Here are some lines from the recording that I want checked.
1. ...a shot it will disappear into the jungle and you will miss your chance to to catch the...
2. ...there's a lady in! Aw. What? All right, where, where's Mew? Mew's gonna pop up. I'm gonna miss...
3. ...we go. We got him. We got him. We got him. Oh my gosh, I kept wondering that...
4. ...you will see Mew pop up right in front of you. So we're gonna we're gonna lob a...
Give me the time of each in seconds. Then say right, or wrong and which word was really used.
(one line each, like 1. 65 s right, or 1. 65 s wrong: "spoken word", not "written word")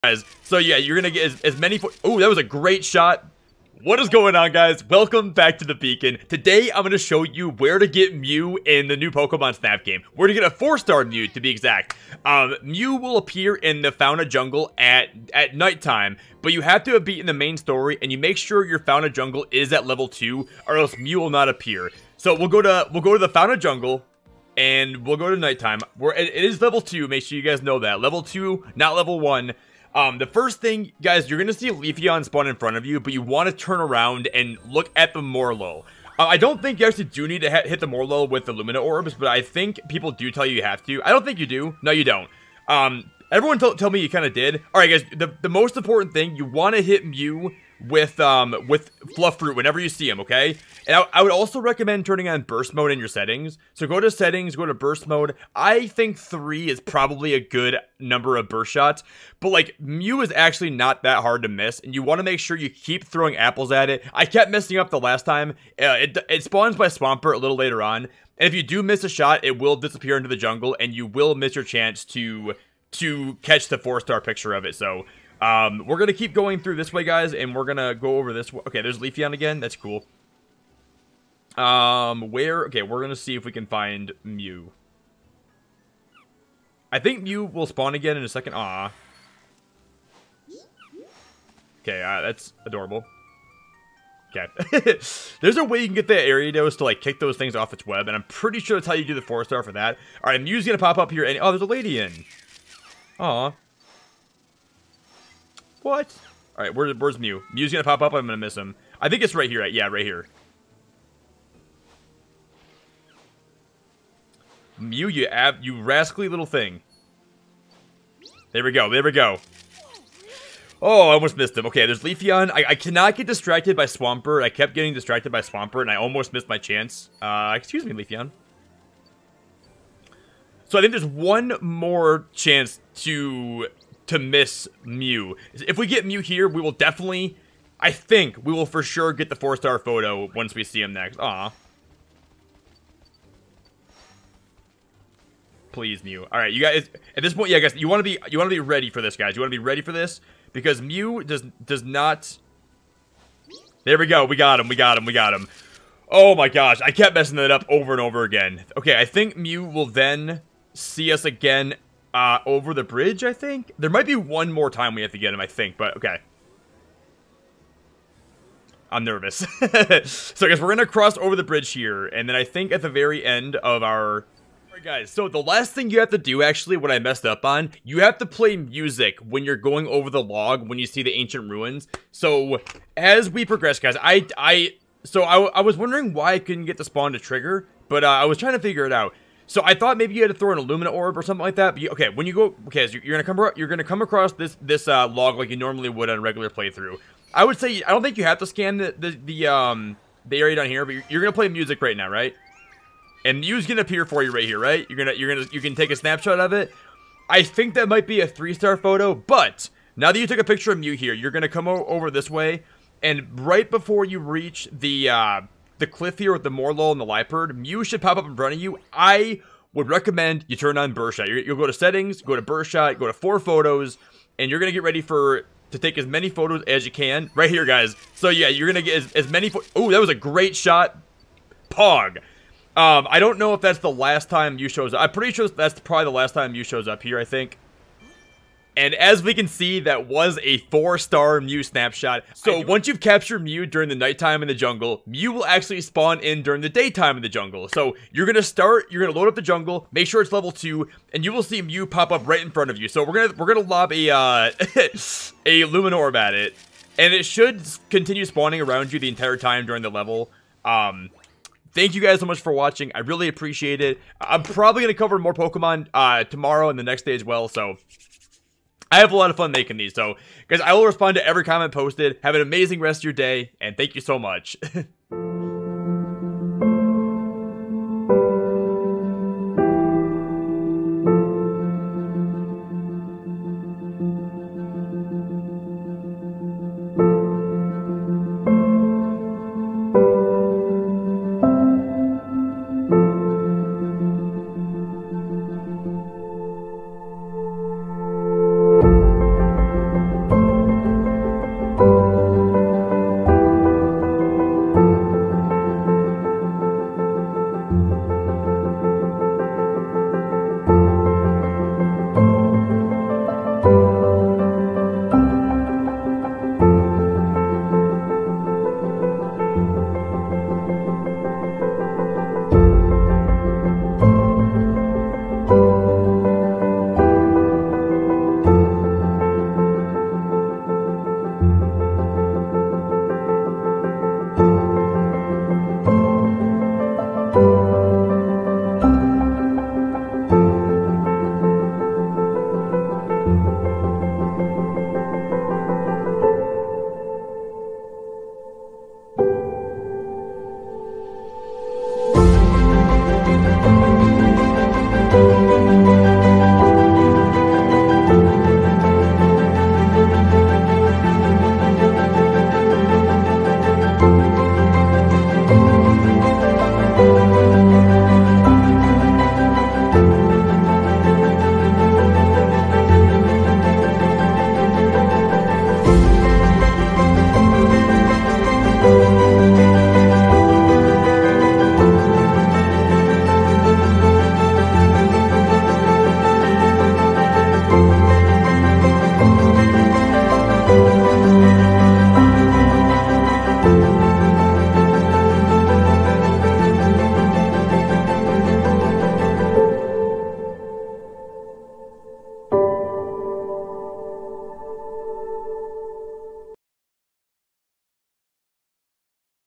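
1. 69 s right
2. 101 s right
3. 153 s wrong: "messing", not "wondering"
4. 251 s right.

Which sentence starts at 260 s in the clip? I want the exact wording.
Um, thank you guys so much for watching.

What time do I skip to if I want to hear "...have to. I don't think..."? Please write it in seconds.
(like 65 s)
40 s.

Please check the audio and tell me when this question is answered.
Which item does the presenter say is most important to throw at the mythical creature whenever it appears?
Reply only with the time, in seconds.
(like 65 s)
49 s.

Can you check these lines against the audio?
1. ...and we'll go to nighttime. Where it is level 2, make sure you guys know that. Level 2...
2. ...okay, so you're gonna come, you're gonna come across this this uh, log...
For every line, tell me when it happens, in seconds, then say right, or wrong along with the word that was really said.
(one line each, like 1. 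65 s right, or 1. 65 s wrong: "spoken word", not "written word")
1. 24 s right
2. 192 s right.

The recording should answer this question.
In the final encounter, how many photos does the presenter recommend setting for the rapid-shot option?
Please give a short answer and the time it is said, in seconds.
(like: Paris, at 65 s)
4, at 223 s.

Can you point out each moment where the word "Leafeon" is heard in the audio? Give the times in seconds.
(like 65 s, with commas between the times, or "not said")
31 s, 78 s, 122 s, 127 s.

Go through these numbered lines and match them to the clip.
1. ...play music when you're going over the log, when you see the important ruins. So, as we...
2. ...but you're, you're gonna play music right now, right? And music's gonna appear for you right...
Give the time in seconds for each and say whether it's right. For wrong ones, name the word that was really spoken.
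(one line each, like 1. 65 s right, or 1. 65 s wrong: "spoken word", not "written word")
1. 178 s wrong: "ancient", not "important"
2. 200 s right.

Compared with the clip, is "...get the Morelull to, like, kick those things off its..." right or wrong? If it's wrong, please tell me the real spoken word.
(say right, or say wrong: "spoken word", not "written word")
wrong: "Ariados", not "Morelull".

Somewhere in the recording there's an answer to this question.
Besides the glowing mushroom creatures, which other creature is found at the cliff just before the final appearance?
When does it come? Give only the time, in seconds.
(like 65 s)
217 s.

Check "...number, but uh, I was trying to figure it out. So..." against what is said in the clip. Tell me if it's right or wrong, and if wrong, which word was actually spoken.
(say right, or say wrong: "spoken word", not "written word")
wrong: "trigger", not "number".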